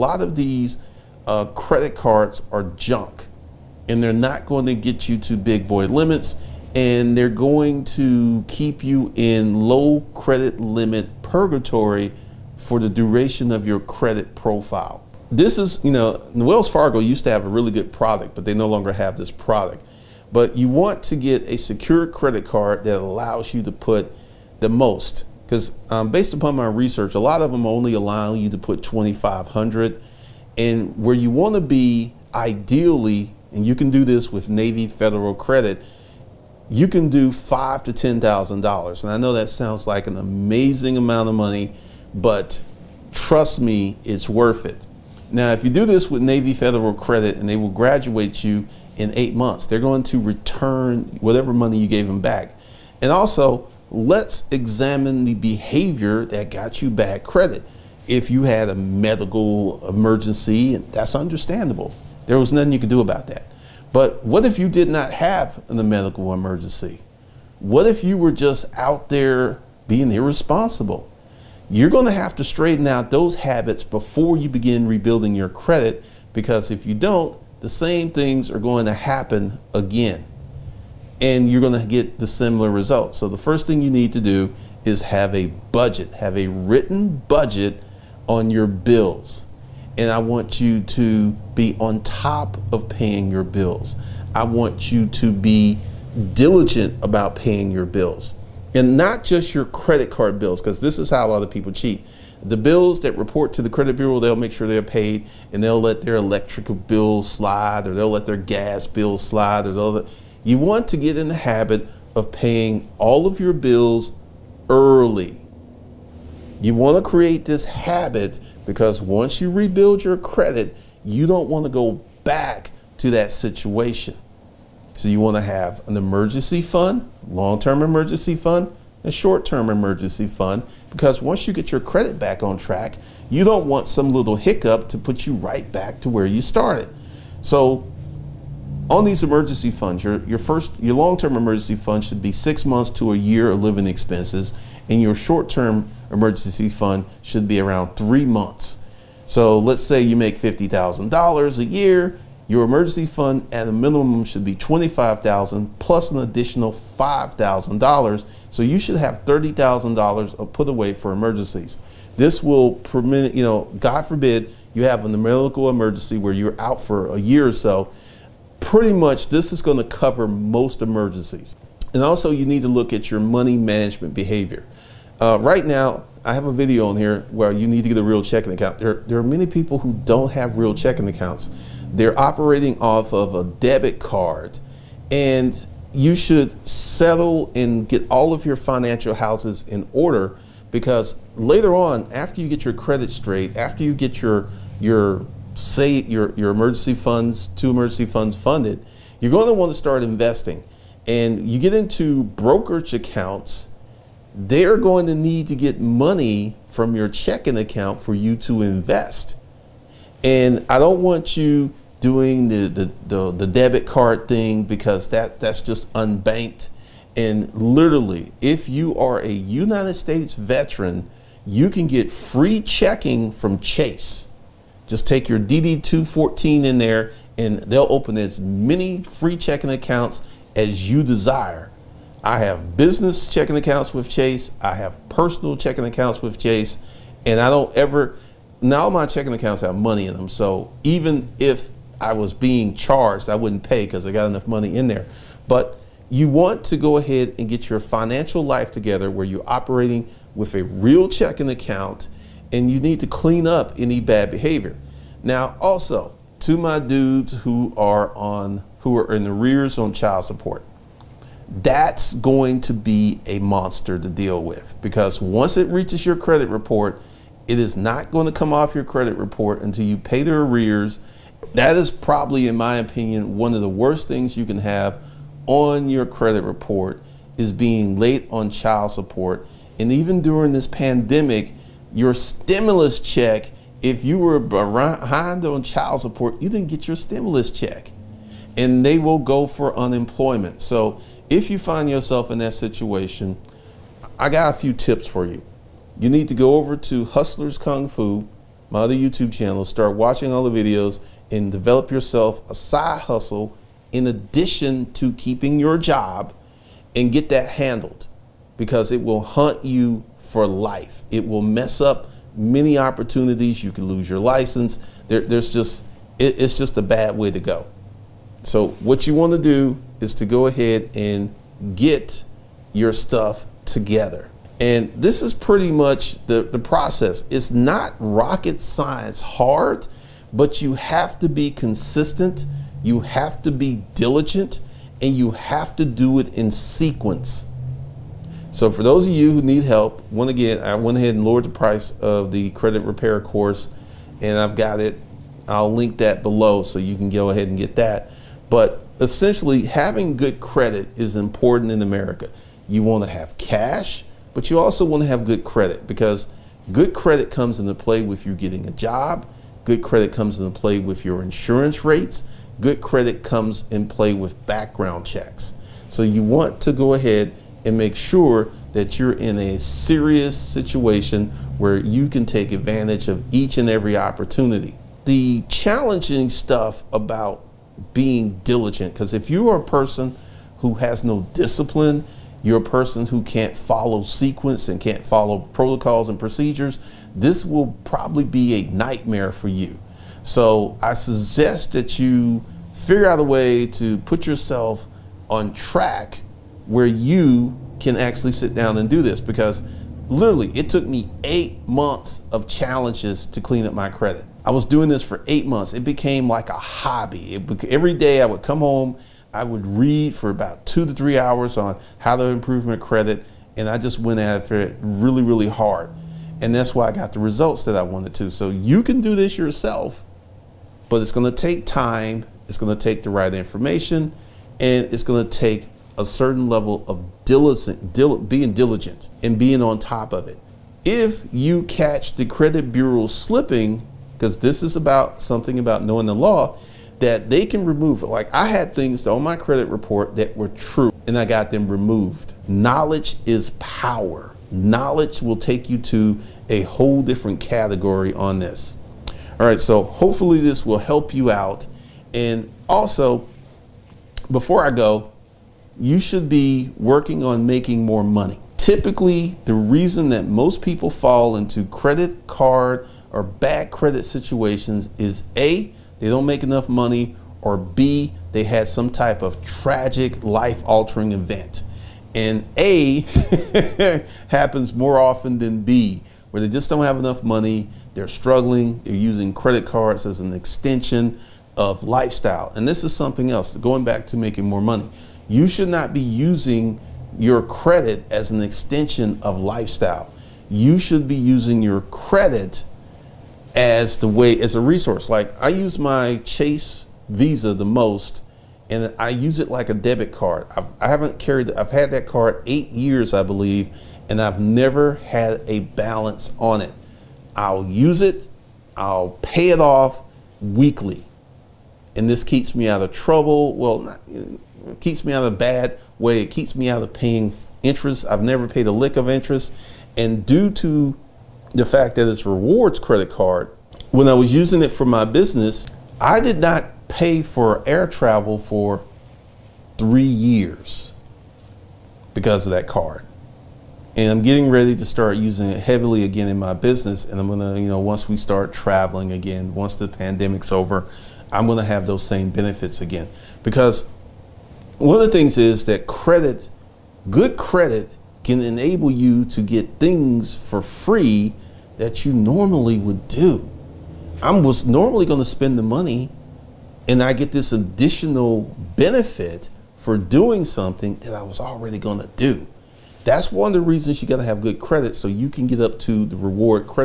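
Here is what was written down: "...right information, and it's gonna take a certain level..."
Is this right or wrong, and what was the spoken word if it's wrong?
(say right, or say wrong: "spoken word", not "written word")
right.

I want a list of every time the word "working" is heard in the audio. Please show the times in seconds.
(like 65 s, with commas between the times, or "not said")
456 s.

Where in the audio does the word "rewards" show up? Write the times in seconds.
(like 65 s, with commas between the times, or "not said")
522 s, 566 s.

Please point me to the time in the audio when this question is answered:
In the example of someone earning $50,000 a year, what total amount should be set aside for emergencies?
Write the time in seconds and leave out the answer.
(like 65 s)
159 s.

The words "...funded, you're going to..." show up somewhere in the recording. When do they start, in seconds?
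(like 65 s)
198 s.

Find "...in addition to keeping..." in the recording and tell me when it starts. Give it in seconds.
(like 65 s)
303 s.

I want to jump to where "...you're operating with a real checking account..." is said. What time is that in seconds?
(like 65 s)
249 s.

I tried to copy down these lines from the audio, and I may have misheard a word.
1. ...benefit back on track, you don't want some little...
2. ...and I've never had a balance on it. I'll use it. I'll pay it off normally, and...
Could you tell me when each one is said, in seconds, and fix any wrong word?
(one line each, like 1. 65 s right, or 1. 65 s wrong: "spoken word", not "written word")
1. 131 s wrong: "credit", not "benefit"
2. 504 s wrong: "weekly", not "normally".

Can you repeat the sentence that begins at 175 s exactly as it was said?
Uh, right now, I have a video on here where you need to get a real checking account.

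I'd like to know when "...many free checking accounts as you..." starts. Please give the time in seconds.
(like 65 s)
228 s.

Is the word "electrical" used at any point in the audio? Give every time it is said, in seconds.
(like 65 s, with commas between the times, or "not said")
106 s.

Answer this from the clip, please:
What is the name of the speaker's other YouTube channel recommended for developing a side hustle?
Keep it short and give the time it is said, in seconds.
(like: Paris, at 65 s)
Hustlers Kung Fu, at 297 s.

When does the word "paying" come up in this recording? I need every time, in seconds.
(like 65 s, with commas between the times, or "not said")
92 s, 97 s, 112 s, 516 s.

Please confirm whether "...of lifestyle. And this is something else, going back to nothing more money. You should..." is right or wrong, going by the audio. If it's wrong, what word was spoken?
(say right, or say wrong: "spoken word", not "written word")
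wrong: "making", not "nothing".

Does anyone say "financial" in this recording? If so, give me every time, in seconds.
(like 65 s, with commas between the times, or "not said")
188 s, 247 s.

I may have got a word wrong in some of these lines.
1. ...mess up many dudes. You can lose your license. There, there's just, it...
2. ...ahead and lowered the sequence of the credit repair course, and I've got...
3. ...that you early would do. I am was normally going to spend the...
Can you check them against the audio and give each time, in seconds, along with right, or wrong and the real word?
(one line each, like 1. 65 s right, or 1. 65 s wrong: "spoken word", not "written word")
1. 311 s wrong: "opportunities", not "dudes"
2. 340 s wrong: "price", not "sequence"
3. 551 s wrong: "normally", not "early".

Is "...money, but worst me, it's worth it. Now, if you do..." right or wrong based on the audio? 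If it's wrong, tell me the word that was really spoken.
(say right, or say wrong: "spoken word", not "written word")
wrong: "trust", not "worst".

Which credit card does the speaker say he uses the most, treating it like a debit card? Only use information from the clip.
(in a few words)
Chase Visa.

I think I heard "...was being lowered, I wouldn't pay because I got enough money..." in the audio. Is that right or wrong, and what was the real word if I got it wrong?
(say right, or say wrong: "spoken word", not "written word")
wrong: "charged", not "lowered".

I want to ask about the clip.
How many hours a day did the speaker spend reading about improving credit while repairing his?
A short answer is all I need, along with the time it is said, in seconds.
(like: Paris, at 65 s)
2 to 3 hours, at 410 s.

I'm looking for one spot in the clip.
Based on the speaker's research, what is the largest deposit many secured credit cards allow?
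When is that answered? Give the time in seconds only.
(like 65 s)
28 s.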